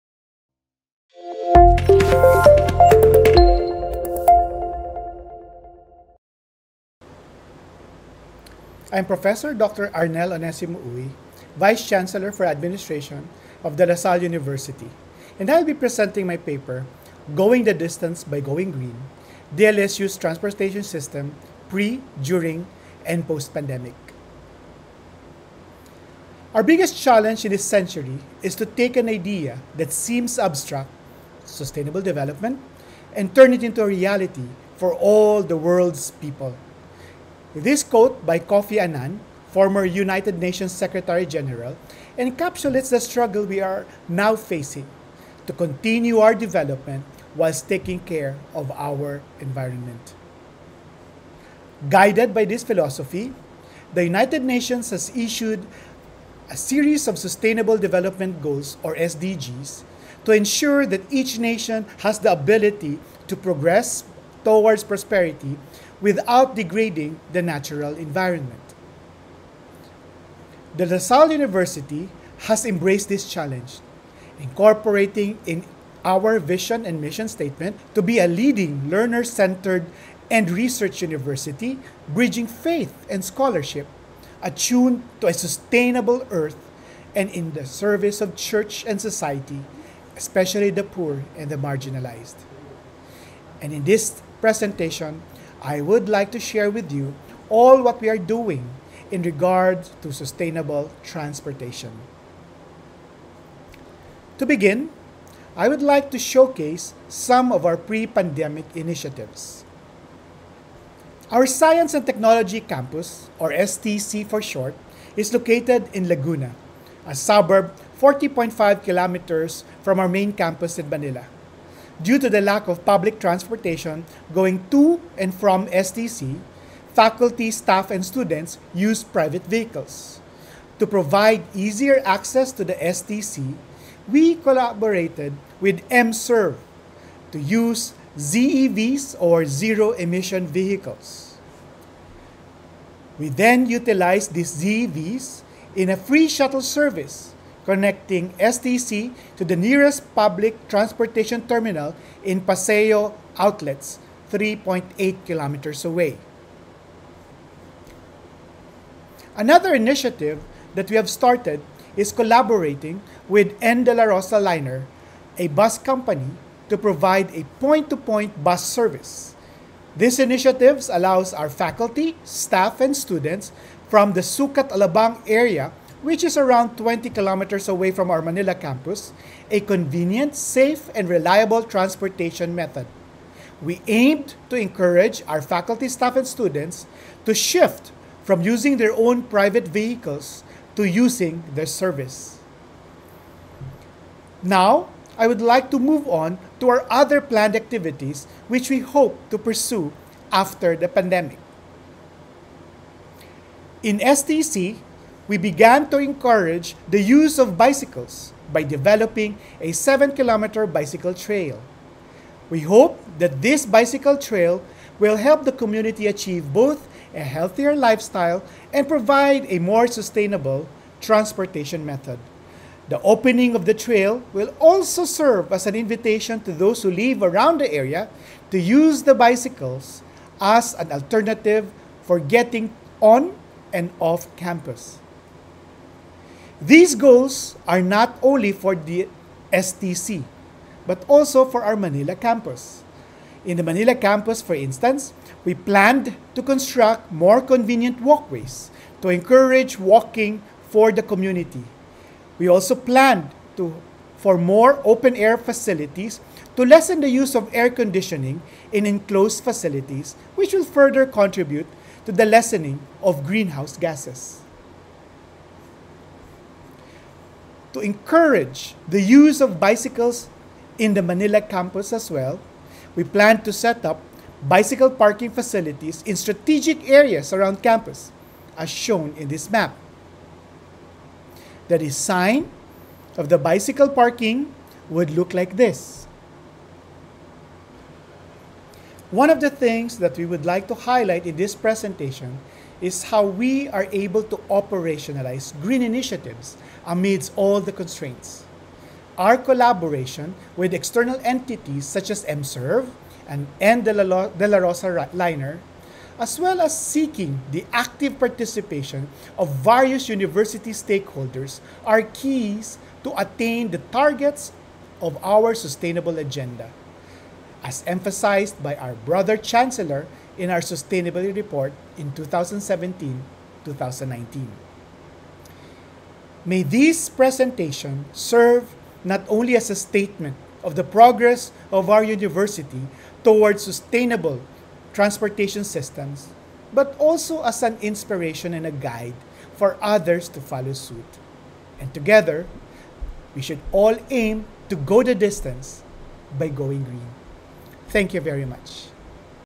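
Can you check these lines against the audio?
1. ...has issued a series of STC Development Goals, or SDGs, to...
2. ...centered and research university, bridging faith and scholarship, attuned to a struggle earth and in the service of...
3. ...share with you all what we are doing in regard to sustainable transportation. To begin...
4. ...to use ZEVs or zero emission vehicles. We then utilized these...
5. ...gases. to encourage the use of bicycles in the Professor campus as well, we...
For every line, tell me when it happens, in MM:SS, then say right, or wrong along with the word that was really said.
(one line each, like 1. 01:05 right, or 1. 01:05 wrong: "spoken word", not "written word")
1. 00:54 wrong: "Sustainable", not "STC"
2. 01:19 wrong: "sustainable", not "struggle"
3. 01:36 right
4. 02:17 right
5. 04:23 wrong: "Manila", not "Professor".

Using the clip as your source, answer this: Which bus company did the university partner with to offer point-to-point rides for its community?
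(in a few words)
N. De La Rosa Liner.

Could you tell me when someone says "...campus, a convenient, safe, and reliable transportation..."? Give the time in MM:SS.
02:58.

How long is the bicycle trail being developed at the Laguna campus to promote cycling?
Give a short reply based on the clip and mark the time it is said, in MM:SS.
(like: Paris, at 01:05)
7 kilometers, at 03:29.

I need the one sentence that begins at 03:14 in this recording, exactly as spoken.
Now, I would like to move on to our other planned activities which we hope to pursue after the pandemic.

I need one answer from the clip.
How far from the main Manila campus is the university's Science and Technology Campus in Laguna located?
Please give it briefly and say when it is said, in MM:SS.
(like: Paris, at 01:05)
40.5 kilometers, at 01:58.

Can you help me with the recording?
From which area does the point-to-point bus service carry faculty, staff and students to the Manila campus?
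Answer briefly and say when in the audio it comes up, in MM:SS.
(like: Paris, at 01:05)
Sucat Alabang, at 02:54.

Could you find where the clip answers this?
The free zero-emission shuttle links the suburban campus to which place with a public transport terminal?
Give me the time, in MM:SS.
02:32.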